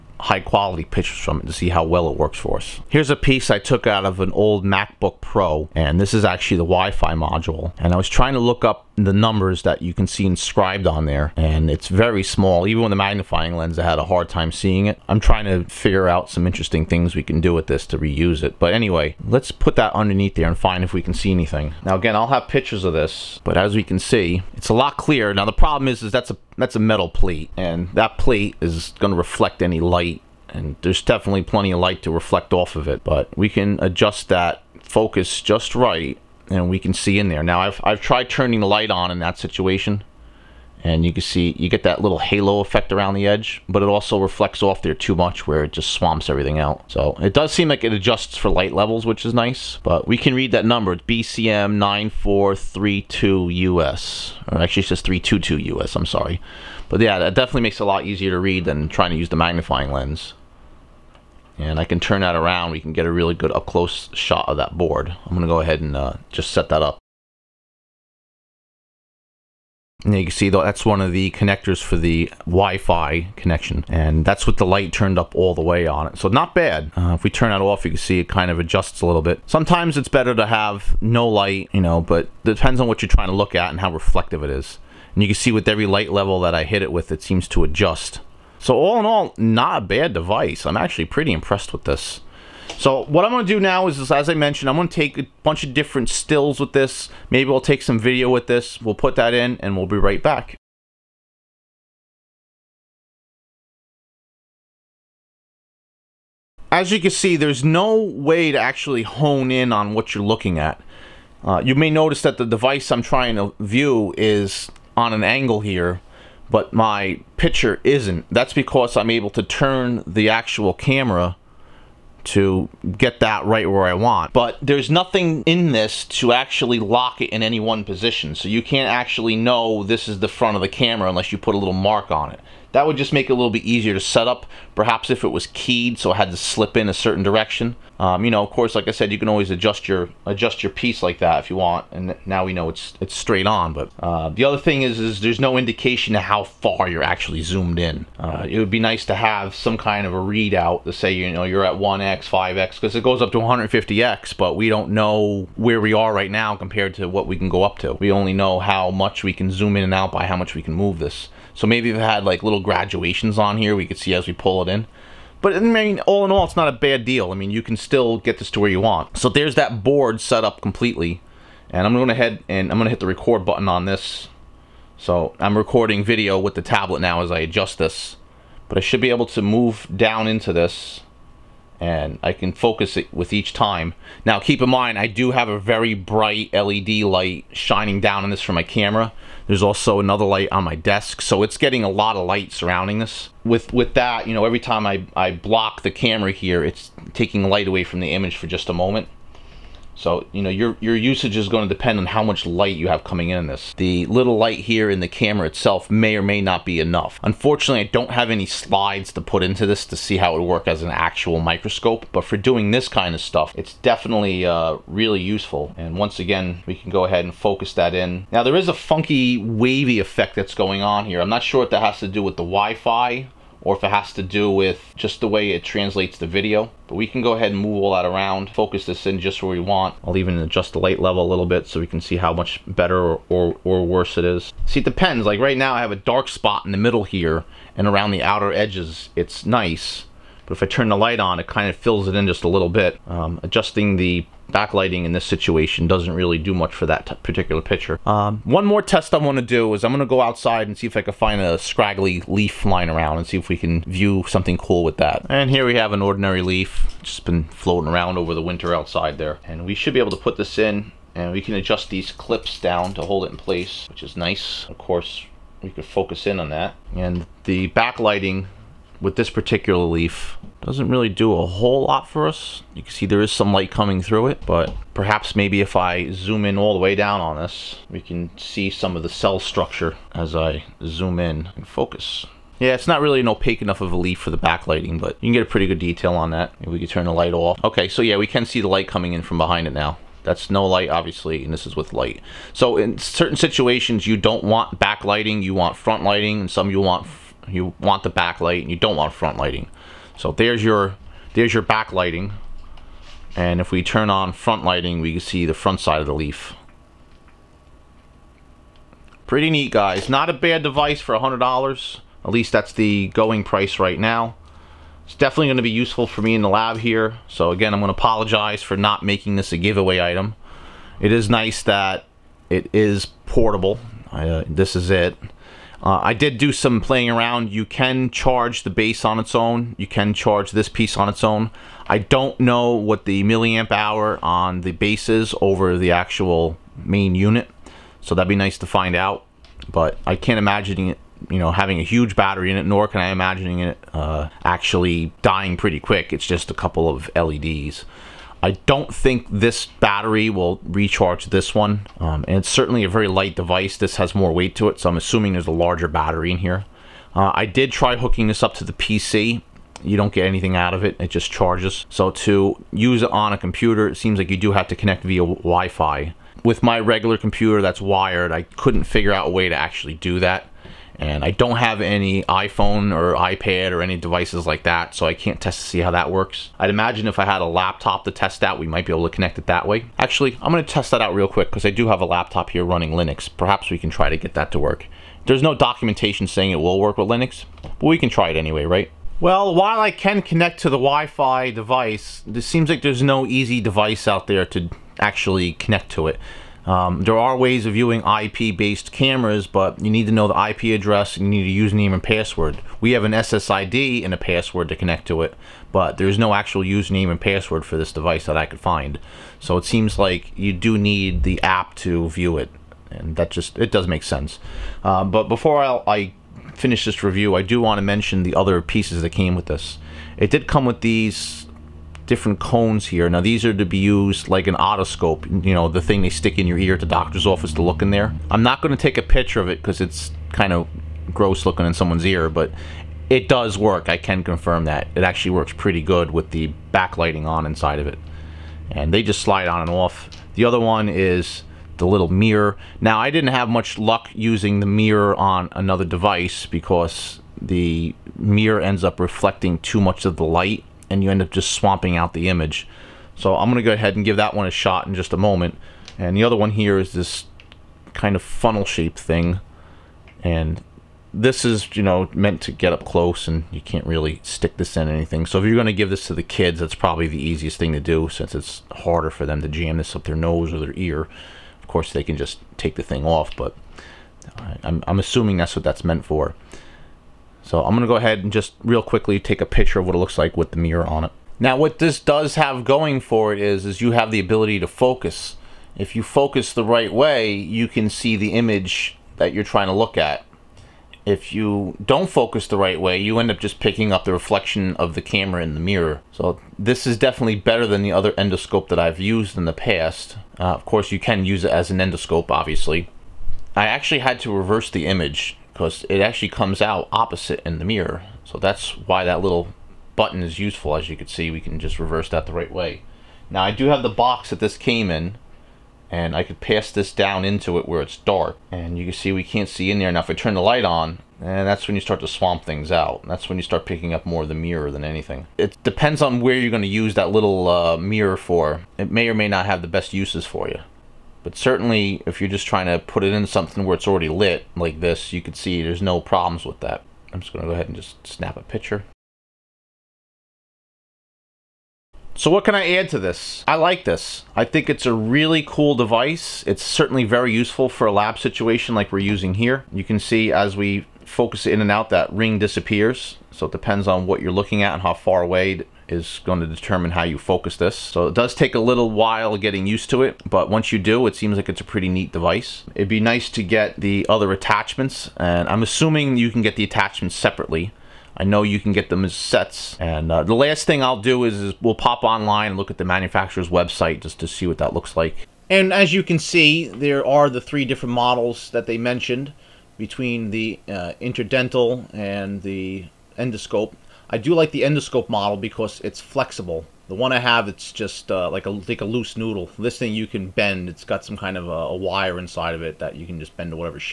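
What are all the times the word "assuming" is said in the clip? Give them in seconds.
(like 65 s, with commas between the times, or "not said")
354 s, 474 s, 565 s.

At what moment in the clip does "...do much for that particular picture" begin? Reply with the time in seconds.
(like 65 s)
246 s.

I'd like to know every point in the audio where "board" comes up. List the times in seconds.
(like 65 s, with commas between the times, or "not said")
64 s, 169 s.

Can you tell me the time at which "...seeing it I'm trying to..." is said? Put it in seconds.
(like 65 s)
14 s.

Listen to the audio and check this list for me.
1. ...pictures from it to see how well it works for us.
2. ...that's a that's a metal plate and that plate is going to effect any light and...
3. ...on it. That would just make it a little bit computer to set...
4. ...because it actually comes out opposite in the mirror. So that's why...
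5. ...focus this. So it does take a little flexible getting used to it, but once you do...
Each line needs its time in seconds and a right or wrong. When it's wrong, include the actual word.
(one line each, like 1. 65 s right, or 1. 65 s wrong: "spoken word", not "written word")
1. 0 s right
2. 26 s wrong: "reflect", not "effect"
3. 132 s wrong: "easier", not "computer"
4. 505 s right
5. 557 s wrong: "while", not "flexible".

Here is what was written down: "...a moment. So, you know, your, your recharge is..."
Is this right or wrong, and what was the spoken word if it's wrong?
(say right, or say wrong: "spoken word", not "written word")
wrong: "usage", not "recharge".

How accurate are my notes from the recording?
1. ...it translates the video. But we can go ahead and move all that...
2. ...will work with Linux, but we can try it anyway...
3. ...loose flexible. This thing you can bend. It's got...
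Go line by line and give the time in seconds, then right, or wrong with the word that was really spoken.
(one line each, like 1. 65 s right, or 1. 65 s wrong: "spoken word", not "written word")
1. 225 s right
2. 386 s right
3. 588 s wrong: "noodle", not "flexible".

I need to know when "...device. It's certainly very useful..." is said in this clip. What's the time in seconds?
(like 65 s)
545 s.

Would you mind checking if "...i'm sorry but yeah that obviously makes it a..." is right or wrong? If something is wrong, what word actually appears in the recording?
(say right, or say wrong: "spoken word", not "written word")
wrong: "definitely", not "obviously".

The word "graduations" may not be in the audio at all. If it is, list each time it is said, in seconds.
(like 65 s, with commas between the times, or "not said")
162 s.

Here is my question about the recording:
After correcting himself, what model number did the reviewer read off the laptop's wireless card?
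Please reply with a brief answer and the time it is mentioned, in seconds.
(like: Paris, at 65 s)
BCM 94322 US, at 51 s.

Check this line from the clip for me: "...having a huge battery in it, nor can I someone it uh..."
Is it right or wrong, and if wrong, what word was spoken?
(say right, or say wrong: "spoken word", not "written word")
wrong: "imagine", not "someone".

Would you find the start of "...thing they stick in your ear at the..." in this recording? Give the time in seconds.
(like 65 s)
425 s.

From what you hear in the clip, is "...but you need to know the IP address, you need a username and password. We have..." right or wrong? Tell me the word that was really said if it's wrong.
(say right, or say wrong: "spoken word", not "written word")
right.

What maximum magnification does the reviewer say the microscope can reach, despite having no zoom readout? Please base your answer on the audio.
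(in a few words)
150x.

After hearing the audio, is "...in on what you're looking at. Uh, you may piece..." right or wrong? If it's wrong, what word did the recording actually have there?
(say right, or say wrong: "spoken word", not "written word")
wrong: "notice", not "piece".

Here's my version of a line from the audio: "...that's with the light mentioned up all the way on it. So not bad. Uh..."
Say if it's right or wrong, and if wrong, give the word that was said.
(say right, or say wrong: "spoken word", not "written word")
wrong: "turned", not "mentioned".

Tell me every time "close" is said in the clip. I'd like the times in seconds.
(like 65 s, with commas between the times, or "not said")
63 s, 462 s.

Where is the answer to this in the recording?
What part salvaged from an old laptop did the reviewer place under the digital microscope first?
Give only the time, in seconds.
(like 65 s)
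6 s.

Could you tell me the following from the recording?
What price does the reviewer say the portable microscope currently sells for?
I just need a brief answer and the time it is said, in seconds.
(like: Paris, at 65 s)
$100, at 311 s.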